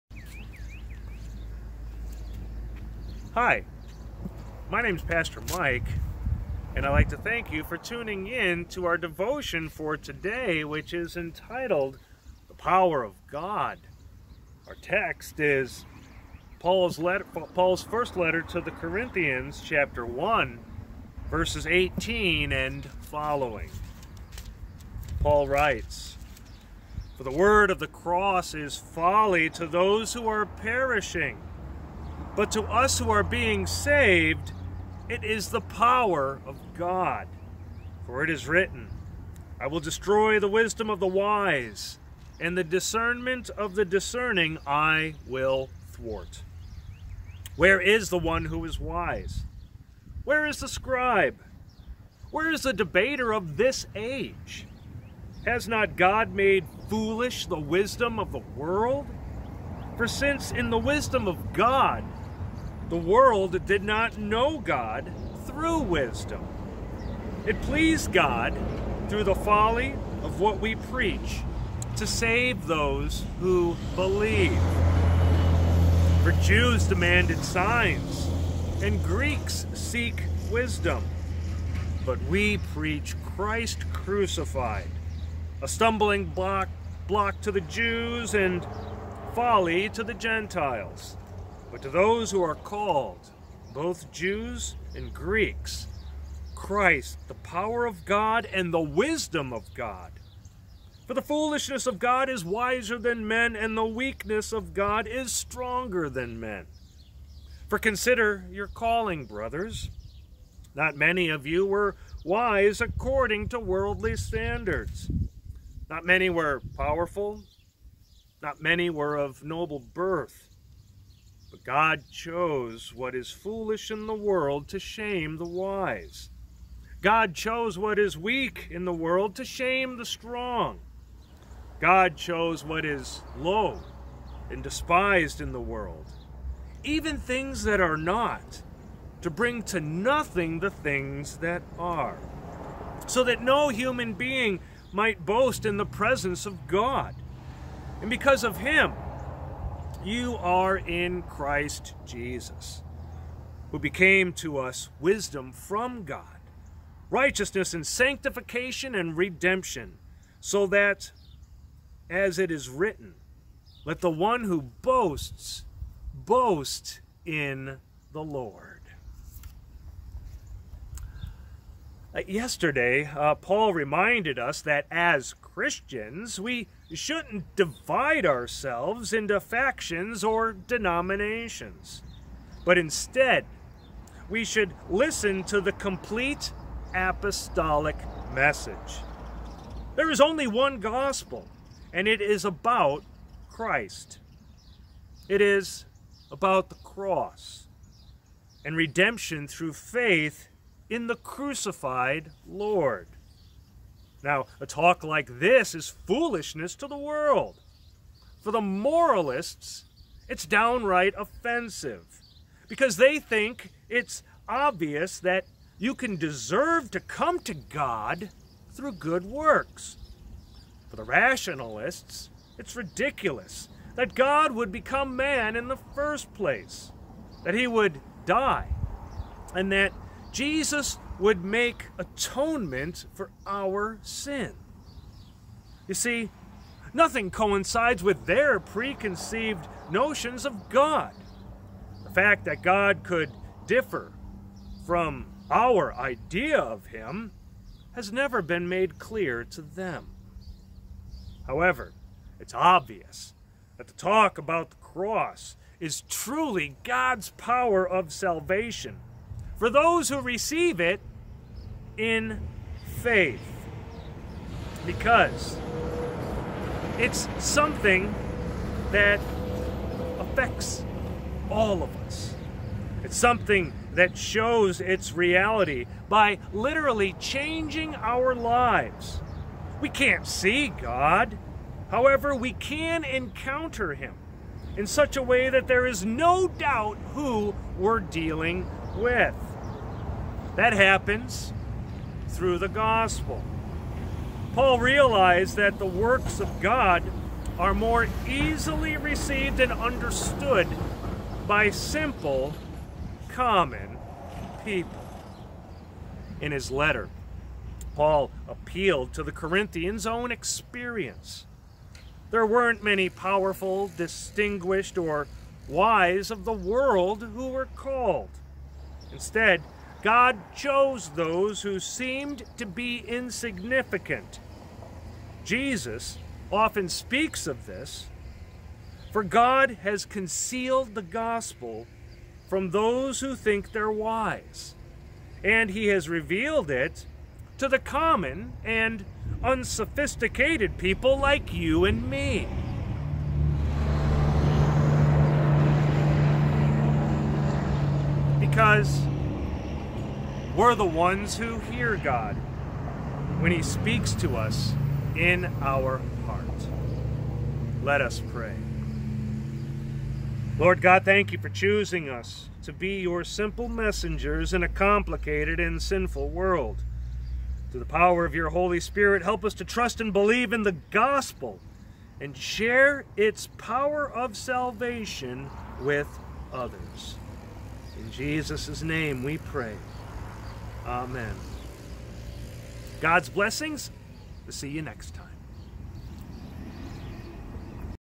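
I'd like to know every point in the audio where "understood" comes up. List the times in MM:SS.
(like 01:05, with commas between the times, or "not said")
04:59.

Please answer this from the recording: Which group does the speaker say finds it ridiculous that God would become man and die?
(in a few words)
the rationalists.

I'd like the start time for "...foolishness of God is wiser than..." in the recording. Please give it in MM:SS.
01:41.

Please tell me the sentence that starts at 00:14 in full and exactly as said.
Our text is Paul's, letter, Paul's first letter to the Corinthians, chapter 1, verses 18 and following.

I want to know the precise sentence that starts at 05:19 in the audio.
Instead, God chose those who seemed to be insignificant.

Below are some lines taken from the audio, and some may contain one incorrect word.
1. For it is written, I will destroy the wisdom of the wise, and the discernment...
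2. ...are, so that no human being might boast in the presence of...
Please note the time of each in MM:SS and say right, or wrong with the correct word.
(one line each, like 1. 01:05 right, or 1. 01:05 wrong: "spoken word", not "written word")
1. 00:38 right
2. 02:21 right.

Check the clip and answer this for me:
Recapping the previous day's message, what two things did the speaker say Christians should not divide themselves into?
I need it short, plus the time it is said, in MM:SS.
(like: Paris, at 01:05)
factions or denominations, at 02:59.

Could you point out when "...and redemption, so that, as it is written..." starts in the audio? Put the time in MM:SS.
02:38.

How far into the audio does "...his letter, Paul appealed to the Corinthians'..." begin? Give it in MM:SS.
05:06.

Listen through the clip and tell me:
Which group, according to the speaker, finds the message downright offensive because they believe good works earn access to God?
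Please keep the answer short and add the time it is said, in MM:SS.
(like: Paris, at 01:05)
the moralists, at 03:28.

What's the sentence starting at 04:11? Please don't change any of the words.
However, it's obvious that the talk about the cross is truly God's power of salvation for those who receive it in faith.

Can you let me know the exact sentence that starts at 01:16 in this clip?
For Jews demanded signs, and Greeks seek wisdom.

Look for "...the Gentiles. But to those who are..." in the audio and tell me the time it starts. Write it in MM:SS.
01:30.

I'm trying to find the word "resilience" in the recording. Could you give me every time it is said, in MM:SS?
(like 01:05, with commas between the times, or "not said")
not said.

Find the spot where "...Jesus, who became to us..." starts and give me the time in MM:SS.
02:32.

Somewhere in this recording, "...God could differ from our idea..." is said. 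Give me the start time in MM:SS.
04:02.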